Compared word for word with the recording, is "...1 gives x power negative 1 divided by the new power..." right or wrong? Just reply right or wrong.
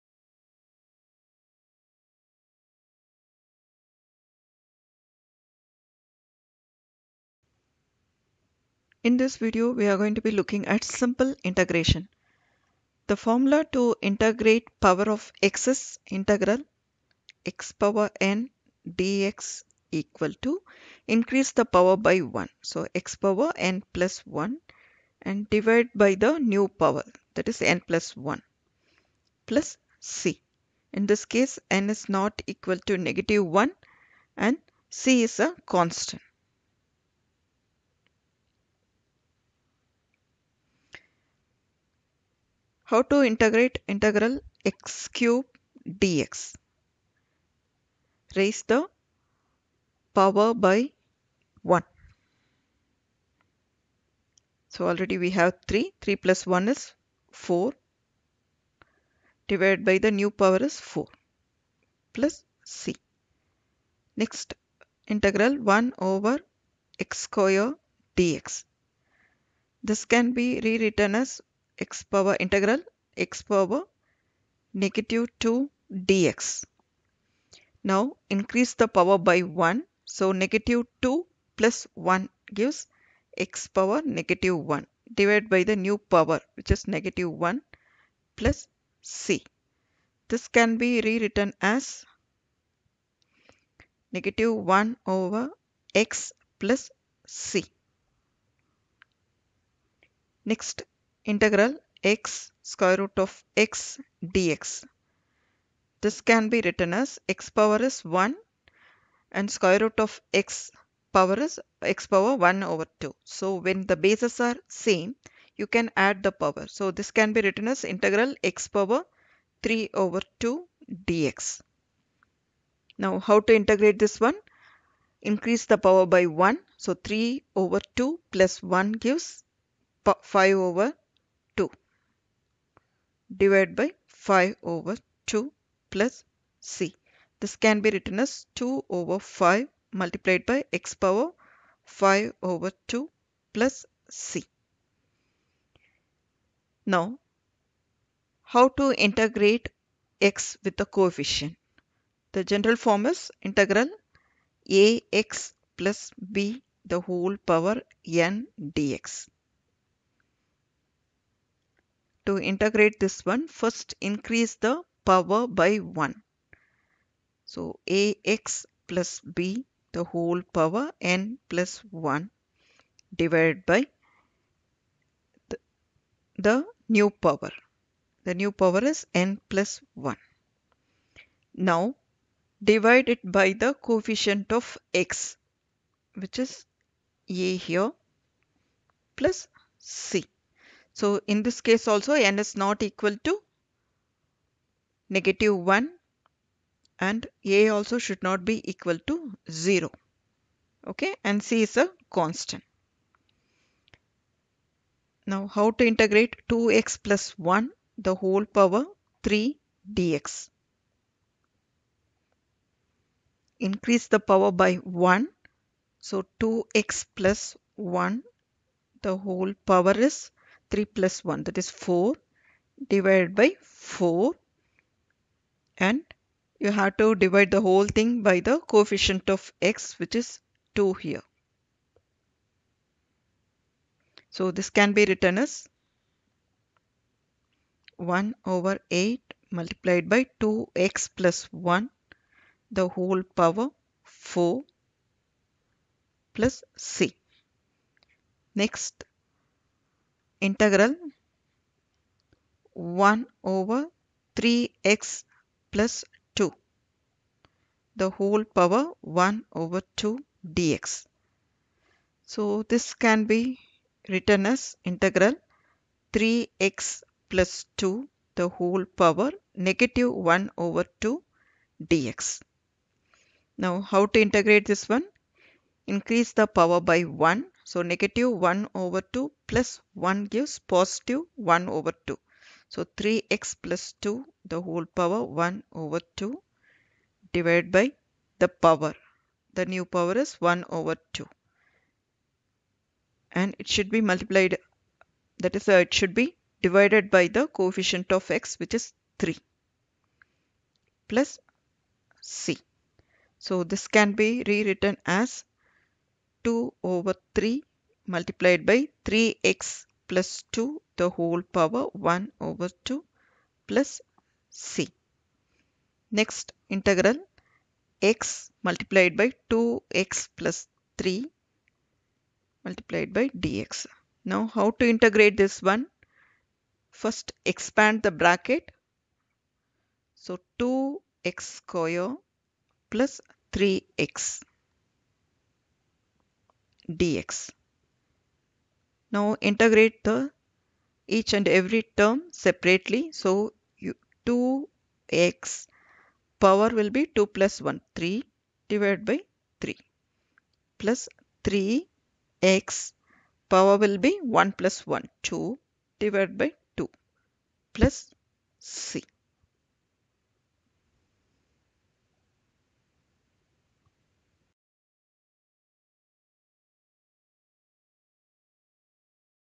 right.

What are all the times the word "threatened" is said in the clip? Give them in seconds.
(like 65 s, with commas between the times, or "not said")
not said.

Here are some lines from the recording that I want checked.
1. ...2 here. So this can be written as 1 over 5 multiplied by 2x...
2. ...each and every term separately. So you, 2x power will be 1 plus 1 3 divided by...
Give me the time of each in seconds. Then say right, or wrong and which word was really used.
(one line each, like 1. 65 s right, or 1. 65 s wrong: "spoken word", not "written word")
1. 230 s wrong: "8", not "5"
2. 341 s wrong: "2", not "1".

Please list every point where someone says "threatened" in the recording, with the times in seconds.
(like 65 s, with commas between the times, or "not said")
not said.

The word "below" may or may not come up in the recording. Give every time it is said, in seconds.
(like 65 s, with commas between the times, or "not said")
not said.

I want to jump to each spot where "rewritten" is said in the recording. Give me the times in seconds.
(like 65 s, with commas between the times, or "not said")
70 s, 91 s, 304 s.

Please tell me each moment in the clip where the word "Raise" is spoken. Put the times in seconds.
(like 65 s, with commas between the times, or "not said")
48 s.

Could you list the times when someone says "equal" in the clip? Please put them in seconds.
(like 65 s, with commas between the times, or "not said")
19 s, 32 s, 192 s, 198 s.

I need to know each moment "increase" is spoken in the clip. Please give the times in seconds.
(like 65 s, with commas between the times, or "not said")
21 s, 78 s, 125 s, 163 s, 213 s, 275 s.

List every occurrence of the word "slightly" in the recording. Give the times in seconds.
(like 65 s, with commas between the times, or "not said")
not said.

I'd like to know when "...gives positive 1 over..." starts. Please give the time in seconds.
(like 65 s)
280 s.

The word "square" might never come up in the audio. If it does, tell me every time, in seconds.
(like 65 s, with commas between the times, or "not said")
67 s, 102 s, 109 s, 331 s.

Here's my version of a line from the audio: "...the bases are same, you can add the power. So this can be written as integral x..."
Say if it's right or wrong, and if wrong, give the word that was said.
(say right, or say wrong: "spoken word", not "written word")
right.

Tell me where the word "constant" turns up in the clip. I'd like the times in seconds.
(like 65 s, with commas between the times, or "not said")
35 s, 202 s.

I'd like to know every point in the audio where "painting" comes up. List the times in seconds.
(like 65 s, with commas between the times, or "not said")
not said.